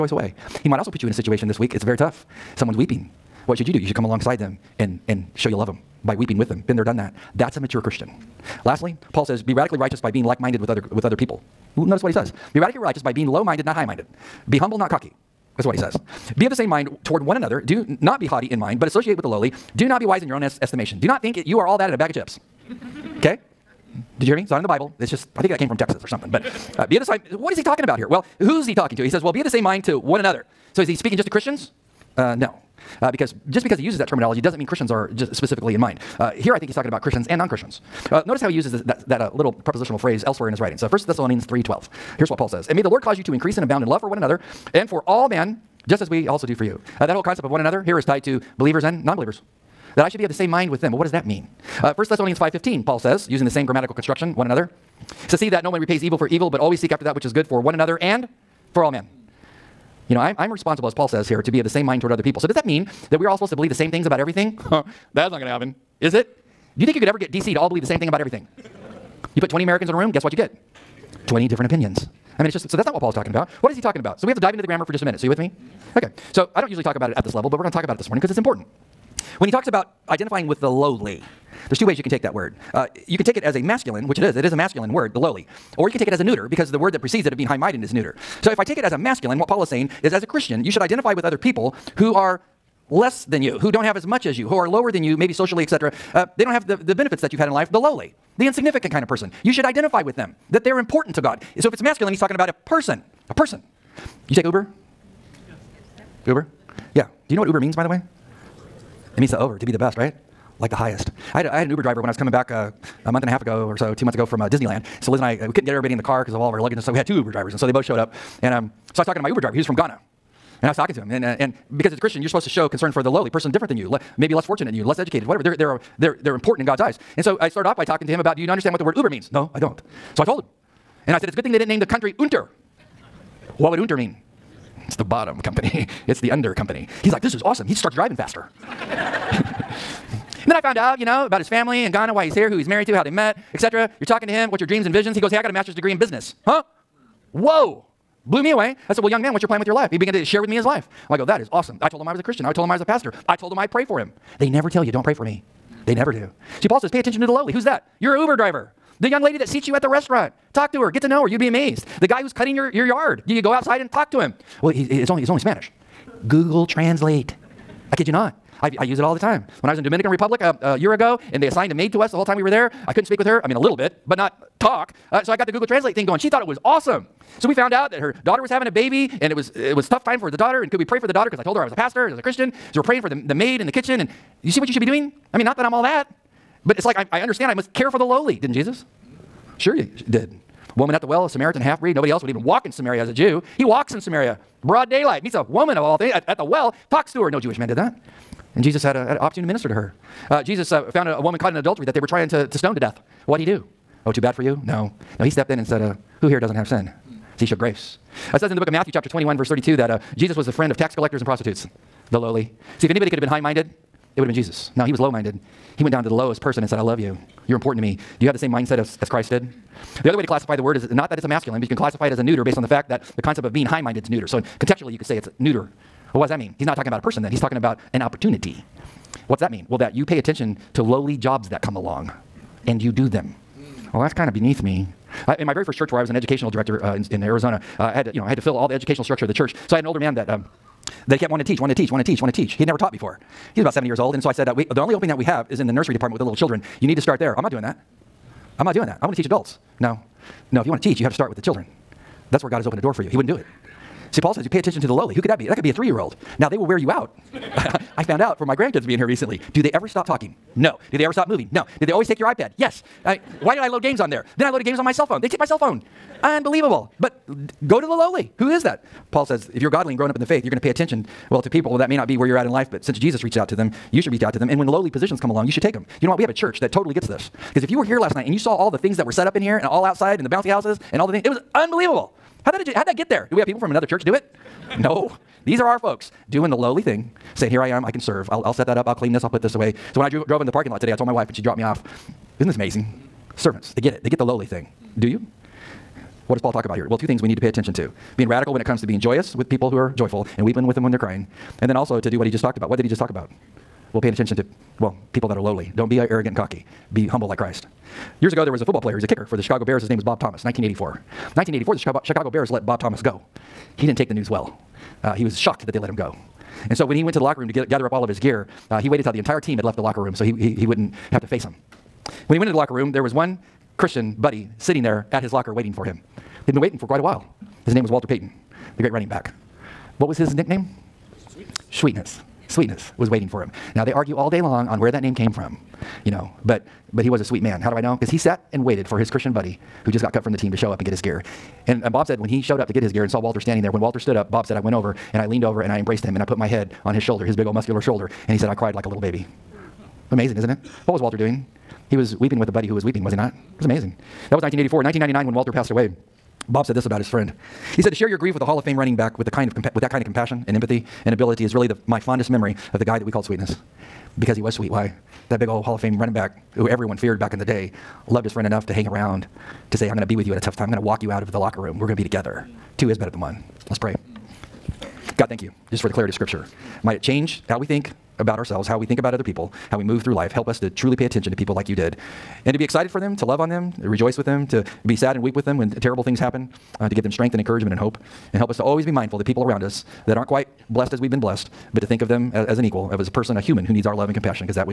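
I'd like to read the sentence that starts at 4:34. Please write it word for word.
And when lowly positions come along, you should take them.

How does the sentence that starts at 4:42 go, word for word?
How'd that, how'd that get there?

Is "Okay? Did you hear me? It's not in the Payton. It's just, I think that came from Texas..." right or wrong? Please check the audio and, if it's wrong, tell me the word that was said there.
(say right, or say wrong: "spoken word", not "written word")
wrong: "Bible", not "Payton".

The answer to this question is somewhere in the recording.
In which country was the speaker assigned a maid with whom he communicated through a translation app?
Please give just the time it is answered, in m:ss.
2:49.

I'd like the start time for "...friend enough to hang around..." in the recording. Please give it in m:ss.
6:08.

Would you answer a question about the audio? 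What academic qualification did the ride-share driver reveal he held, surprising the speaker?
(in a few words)
Master's degree in business.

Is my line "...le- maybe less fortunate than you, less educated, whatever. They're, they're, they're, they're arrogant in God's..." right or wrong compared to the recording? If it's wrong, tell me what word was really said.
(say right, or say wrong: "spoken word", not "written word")
wrong: "important", not "arrogant".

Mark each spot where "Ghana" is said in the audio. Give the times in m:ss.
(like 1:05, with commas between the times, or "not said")
1:59, 2:21.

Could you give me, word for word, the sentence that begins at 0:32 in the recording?
Uh, no uh, because just because he uses that terminology doesn't mean Christians are just specifically in mind.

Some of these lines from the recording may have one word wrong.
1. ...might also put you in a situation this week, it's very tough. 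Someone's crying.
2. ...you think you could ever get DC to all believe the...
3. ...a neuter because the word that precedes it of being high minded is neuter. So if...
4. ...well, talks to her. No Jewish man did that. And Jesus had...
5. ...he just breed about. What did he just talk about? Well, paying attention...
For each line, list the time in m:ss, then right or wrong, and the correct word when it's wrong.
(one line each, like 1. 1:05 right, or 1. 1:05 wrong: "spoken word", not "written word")
1. 0:00 wrong: "weeping", not "crying"
2. 1:06 right
3. 1:26 right
4. 3:16 right
5. 5:02 wrong: "talked", not "breed".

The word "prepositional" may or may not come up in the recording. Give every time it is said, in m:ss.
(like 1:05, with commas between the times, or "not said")
0:39.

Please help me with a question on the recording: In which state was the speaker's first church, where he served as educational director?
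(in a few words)
Arizona.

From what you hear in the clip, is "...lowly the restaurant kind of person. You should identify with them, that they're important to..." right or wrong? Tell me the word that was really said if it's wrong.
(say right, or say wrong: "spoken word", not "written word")
wrong: "insignificant", not "restaurant".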